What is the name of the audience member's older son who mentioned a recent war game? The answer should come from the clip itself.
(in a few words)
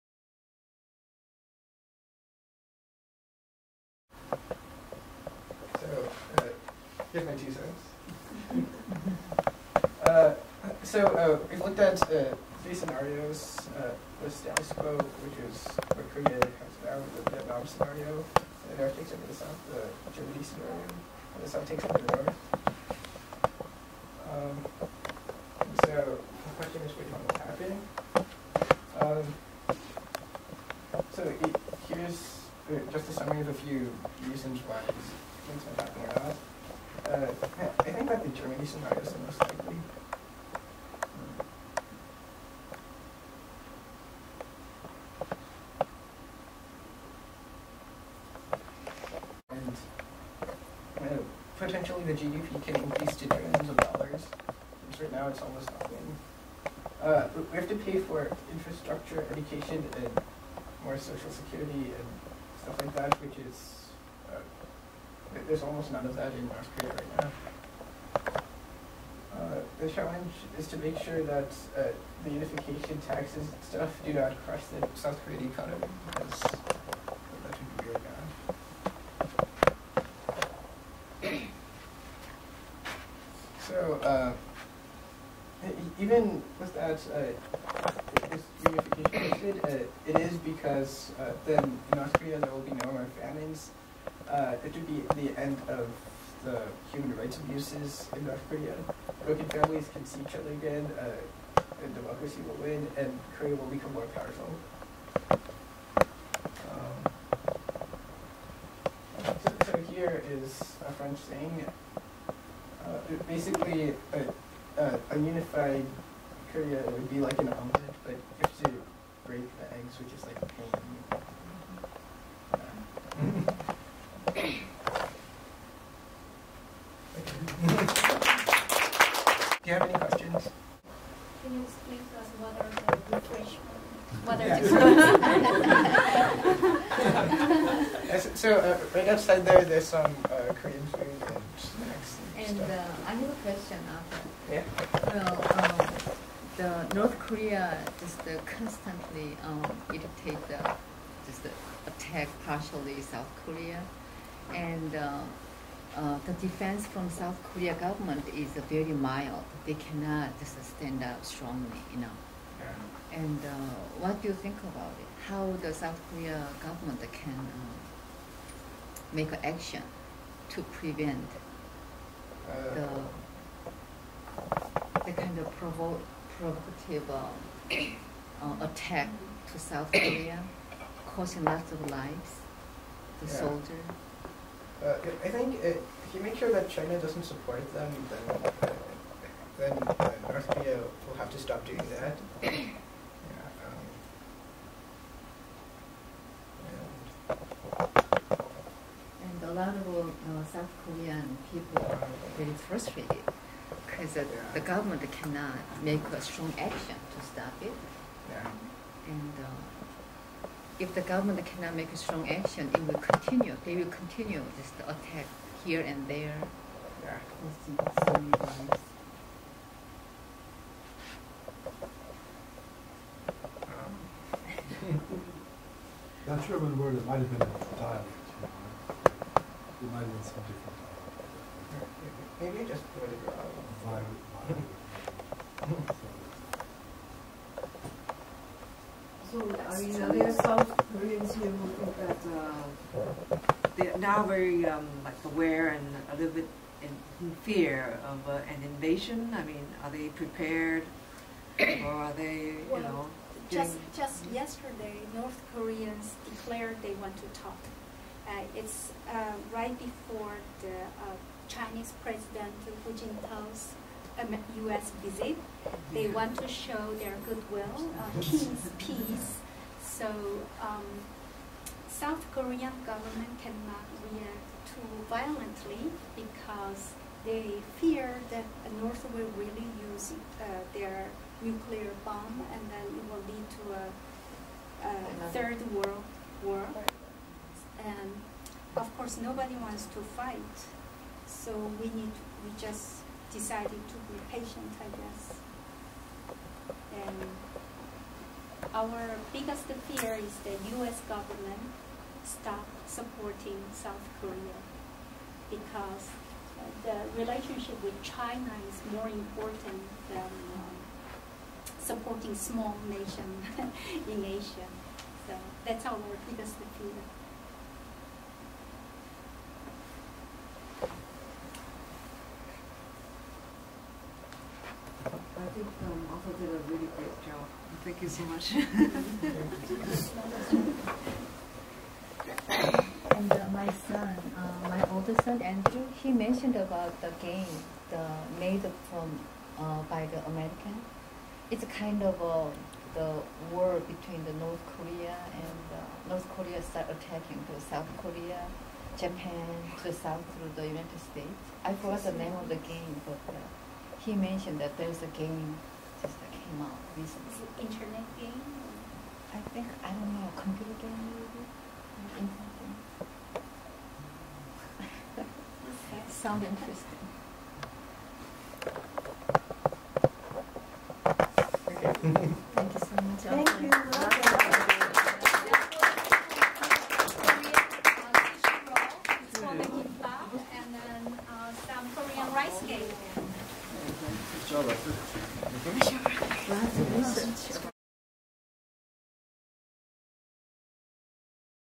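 Andrew.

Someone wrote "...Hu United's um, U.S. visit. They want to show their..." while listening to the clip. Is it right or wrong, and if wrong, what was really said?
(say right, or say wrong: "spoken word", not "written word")
wrong: "Jintao", not "United".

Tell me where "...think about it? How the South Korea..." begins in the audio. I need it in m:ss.
2:44.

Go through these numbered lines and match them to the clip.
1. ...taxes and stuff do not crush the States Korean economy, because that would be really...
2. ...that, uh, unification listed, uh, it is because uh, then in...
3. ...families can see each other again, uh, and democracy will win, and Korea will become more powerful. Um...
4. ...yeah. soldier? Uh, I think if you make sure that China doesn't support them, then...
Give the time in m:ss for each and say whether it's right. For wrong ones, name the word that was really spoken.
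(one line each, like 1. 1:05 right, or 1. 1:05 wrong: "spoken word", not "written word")
1. 1:13 wrong: "South", not "States"
2. 1:26 right
3. 1:39 right
4. 3:03 right.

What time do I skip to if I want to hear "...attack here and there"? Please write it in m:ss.
3:34.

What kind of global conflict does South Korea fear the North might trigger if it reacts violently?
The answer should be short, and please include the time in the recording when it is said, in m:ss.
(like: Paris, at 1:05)
third world war, at 4:45.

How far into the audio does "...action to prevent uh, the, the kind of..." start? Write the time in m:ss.
2:49.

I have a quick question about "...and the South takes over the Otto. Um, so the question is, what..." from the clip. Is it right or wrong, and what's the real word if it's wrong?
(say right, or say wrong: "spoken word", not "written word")
wrong: "North", not "Otto".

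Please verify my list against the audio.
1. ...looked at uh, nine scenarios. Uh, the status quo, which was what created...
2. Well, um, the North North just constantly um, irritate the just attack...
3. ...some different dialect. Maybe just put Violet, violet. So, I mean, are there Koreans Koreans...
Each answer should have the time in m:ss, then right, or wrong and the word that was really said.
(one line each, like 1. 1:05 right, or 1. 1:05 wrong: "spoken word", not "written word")
1. 0:11 wrong: "three", not "nine"
2. 2:25 wrong: "Korea", not "North"
3. 3:50 wrong: "South", not "Koreans".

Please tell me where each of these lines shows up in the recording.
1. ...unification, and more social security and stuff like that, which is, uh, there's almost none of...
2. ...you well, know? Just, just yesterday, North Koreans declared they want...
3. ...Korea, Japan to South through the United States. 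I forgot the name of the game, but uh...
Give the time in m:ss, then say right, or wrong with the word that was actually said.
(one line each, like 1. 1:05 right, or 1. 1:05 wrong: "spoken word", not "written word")
1. 0:59 wrong: "education", not "unification"
2. 4:12 right
3. 5:48 right.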